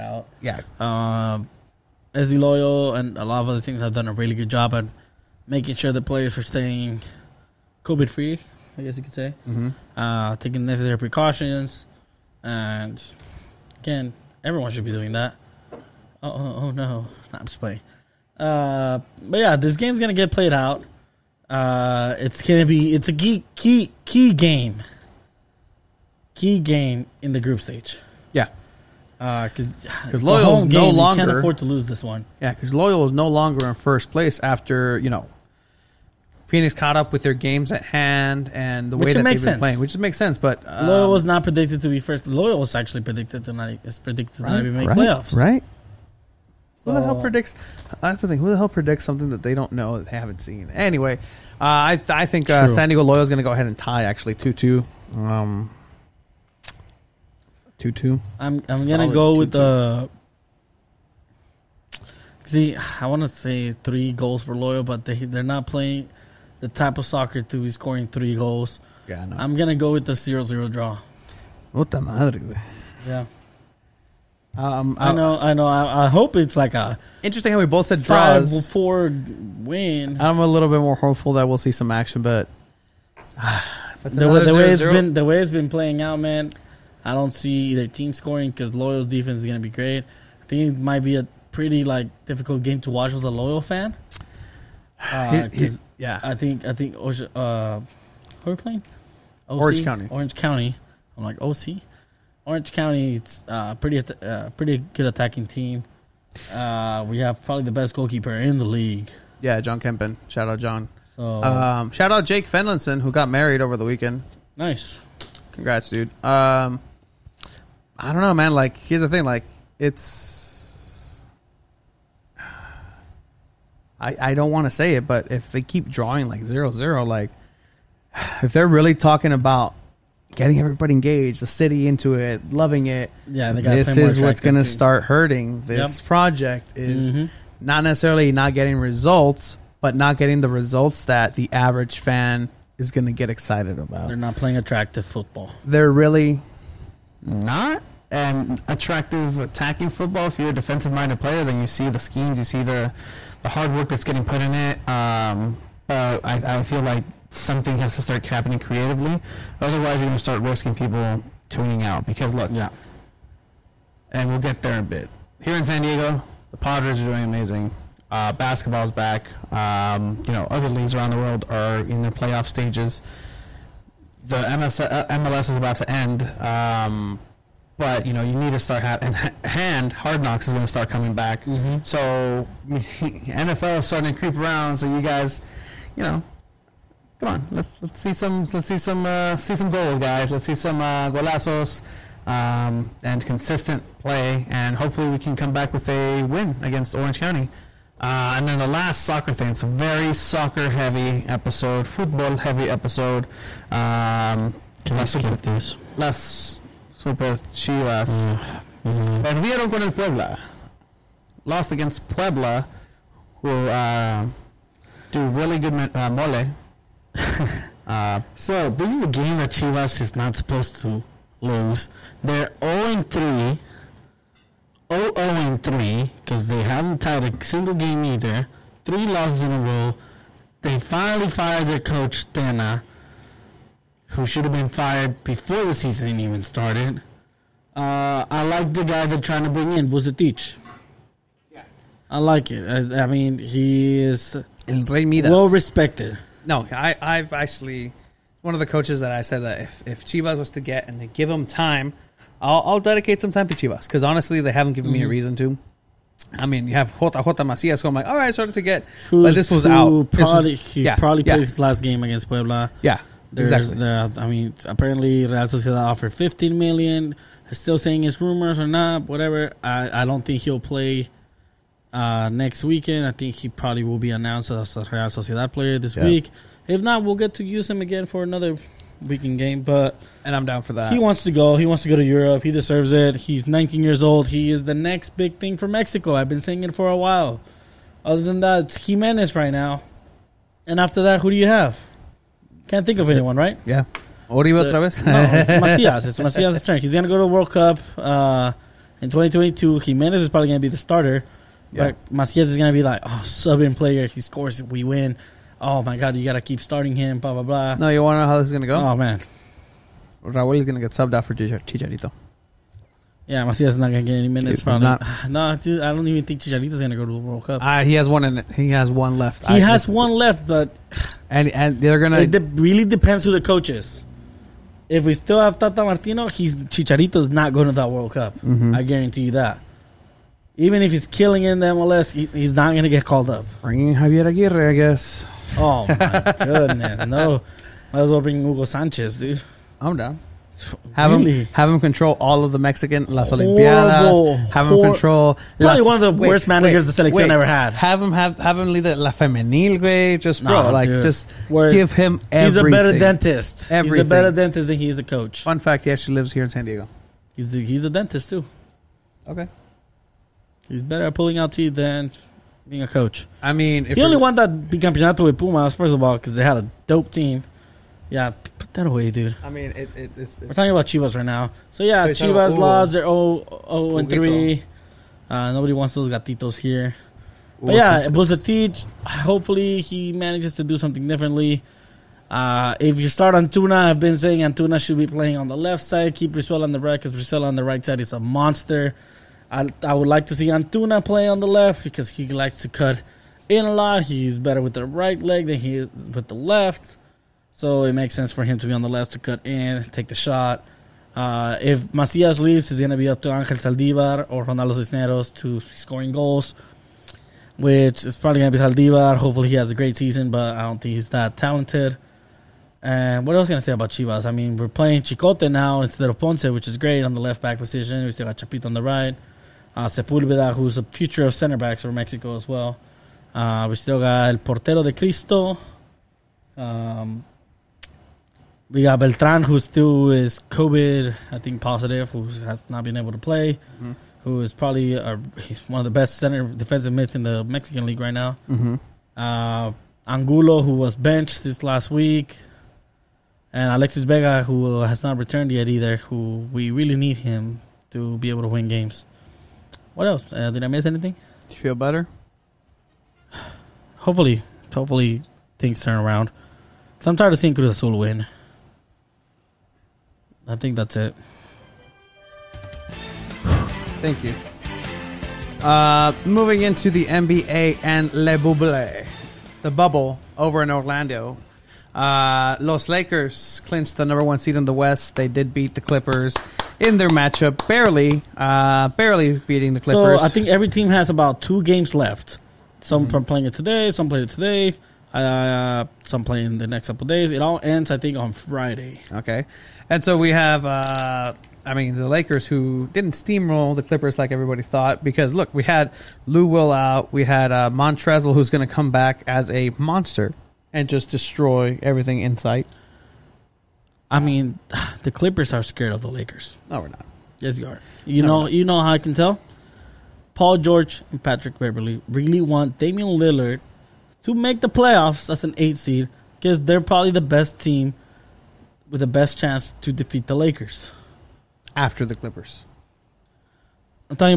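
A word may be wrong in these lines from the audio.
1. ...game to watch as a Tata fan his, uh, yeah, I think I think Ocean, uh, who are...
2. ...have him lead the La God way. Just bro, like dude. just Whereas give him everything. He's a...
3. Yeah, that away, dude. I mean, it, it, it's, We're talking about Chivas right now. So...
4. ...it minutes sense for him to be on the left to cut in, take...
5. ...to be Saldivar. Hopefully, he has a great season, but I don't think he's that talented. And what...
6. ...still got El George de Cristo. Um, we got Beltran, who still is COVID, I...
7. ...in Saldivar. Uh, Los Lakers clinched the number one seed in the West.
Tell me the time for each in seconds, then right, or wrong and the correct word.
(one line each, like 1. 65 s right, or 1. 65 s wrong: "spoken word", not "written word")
1. 92 s wrong: "Loyal", not "Tata"
2. 348 s wrong: "Femenil", not "God"
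3. 368 s right
4. 397 s wrong: "makes", not "minutes"
5. 408 s right
6. 423 s wrong: "Portero", not "George"
7. 470 s wrong: "Orlando", not "Saldivar".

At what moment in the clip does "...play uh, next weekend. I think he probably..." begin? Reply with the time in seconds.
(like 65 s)
270 s.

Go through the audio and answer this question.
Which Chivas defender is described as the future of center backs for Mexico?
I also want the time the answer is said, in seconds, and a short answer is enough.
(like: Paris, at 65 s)
Sepulveda, at 419 s.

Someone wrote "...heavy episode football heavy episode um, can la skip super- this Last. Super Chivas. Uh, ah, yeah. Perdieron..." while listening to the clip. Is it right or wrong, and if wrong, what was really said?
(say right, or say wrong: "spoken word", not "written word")
right.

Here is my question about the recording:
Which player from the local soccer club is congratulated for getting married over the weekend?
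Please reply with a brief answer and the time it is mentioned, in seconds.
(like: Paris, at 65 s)
Jake Fenlinson, at 112 s.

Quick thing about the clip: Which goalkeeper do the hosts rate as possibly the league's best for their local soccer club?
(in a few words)
John Kempen.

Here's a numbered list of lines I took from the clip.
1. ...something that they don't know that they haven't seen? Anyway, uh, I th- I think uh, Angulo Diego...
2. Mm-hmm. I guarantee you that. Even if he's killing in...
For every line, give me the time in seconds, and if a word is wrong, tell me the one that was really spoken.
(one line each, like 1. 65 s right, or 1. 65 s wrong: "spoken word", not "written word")
1. 49 s wrong: "San", not "Angulo"
2. 328 s right.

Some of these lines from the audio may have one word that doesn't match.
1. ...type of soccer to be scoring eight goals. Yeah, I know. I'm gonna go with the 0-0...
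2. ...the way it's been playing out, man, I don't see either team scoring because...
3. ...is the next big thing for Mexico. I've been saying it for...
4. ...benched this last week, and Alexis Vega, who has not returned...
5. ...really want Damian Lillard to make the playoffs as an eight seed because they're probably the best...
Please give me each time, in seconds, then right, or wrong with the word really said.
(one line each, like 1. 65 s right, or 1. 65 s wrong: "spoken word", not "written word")
1. 66 s wrong: "three", not "eight"
2. 85 s right
3. 284 s right
4. 440 s right
5. 512 s right.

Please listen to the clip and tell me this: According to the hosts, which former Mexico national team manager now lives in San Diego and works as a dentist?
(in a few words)
Hugo Sanchez.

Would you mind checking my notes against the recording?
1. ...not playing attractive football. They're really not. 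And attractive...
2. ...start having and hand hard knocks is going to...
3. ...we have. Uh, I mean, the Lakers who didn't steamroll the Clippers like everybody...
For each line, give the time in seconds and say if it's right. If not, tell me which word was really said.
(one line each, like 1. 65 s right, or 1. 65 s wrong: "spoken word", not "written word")
1. 144 s right
2. 178 s right
3. 490 s right.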